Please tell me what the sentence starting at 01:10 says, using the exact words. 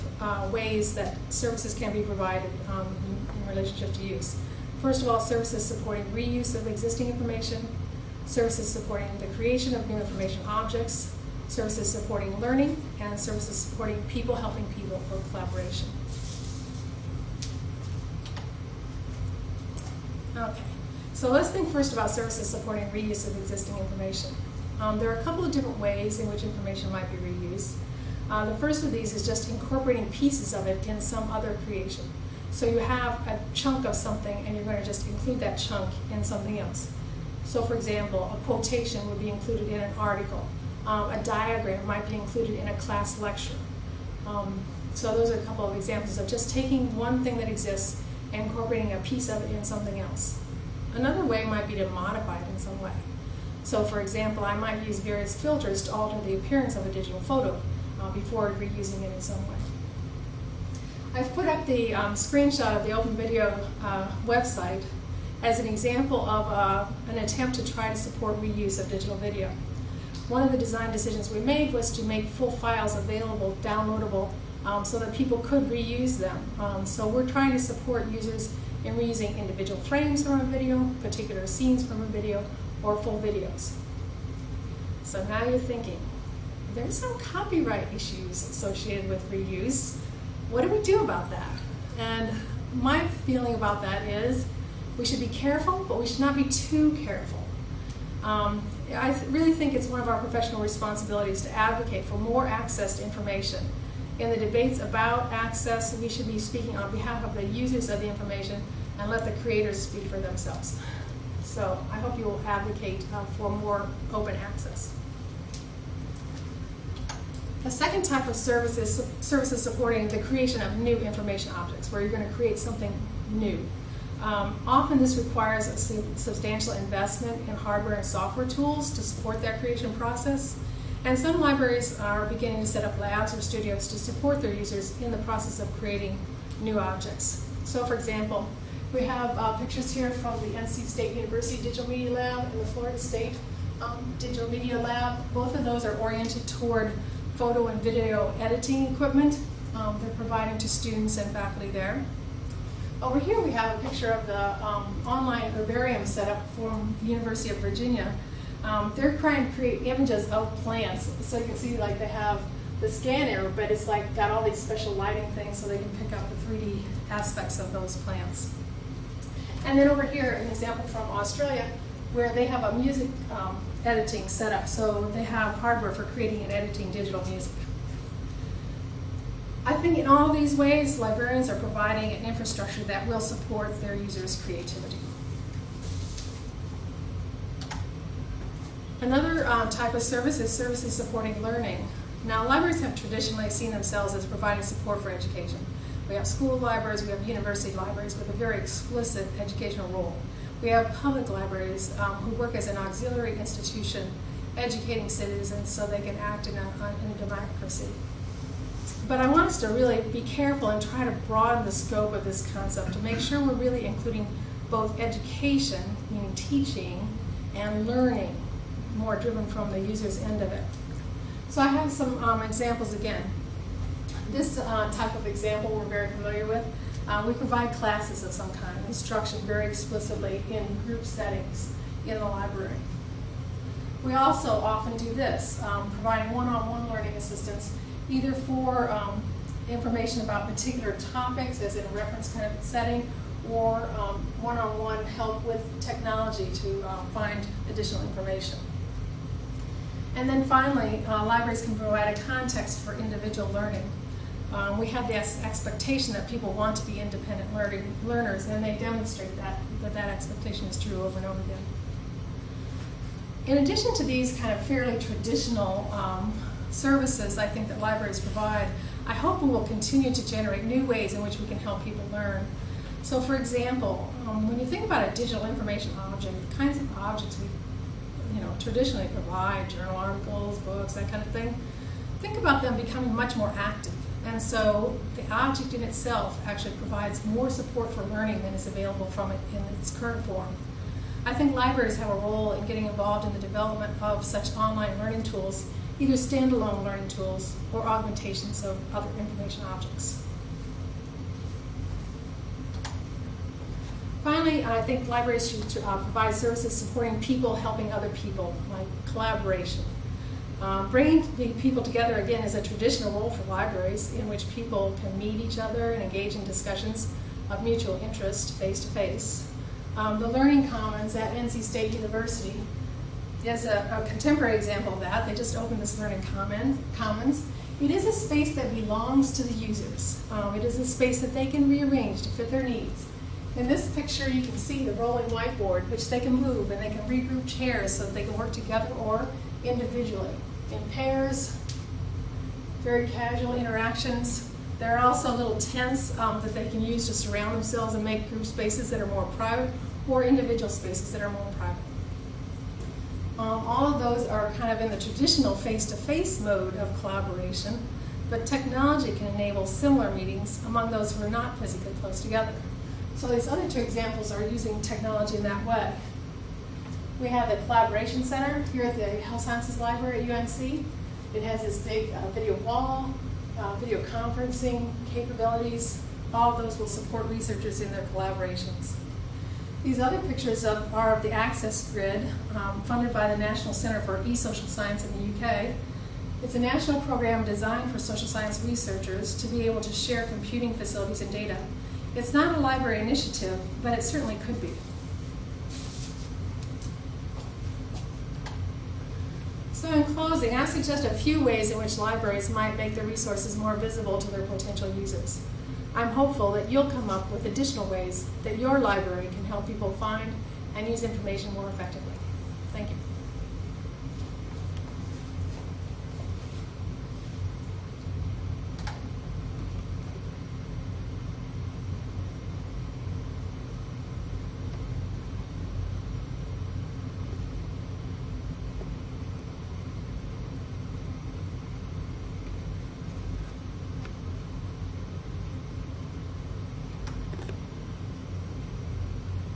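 One of the design decisions we made was to make full files available, downloadable, um, so that people could reuse them.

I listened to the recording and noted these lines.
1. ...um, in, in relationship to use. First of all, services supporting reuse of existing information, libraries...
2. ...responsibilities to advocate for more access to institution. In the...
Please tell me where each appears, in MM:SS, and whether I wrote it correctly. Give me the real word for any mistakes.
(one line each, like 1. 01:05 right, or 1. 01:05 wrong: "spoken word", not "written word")
1. 00:02 wrong: "services", not "libraries"
2. 01:40 wrong: "information", not "institution".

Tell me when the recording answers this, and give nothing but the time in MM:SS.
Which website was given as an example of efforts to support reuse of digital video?
01:02.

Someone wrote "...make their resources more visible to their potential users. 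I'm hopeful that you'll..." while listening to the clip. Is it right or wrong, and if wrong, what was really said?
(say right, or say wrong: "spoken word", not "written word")
right.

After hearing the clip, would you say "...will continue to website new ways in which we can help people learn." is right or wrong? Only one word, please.
wrong.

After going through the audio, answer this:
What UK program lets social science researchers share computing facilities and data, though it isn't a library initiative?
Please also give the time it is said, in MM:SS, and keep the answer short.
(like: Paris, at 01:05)
Access Grid, at 06:21.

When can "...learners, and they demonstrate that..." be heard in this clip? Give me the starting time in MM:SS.
04:17.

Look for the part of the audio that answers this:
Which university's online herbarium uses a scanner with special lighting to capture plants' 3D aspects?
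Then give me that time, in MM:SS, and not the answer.
02:37.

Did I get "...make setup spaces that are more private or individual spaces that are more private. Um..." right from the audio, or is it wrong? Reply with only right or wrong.
wrong.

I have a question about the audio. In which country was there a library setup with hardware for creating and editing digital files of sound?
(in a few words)
Australia.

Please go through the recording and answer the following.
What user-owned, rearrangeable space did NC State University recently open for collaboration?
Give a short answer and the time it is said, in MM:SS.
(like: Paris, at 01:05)
Learning Commons, at 05:20.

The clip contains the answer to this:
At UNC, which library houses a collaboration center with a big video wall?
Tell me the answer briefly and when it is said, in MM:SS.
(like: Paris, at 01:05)
Health Sciences Library, at 06:09.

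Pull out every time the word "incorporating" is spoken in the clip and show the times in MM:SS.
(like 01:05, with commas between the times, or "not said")
00:29, 00:48.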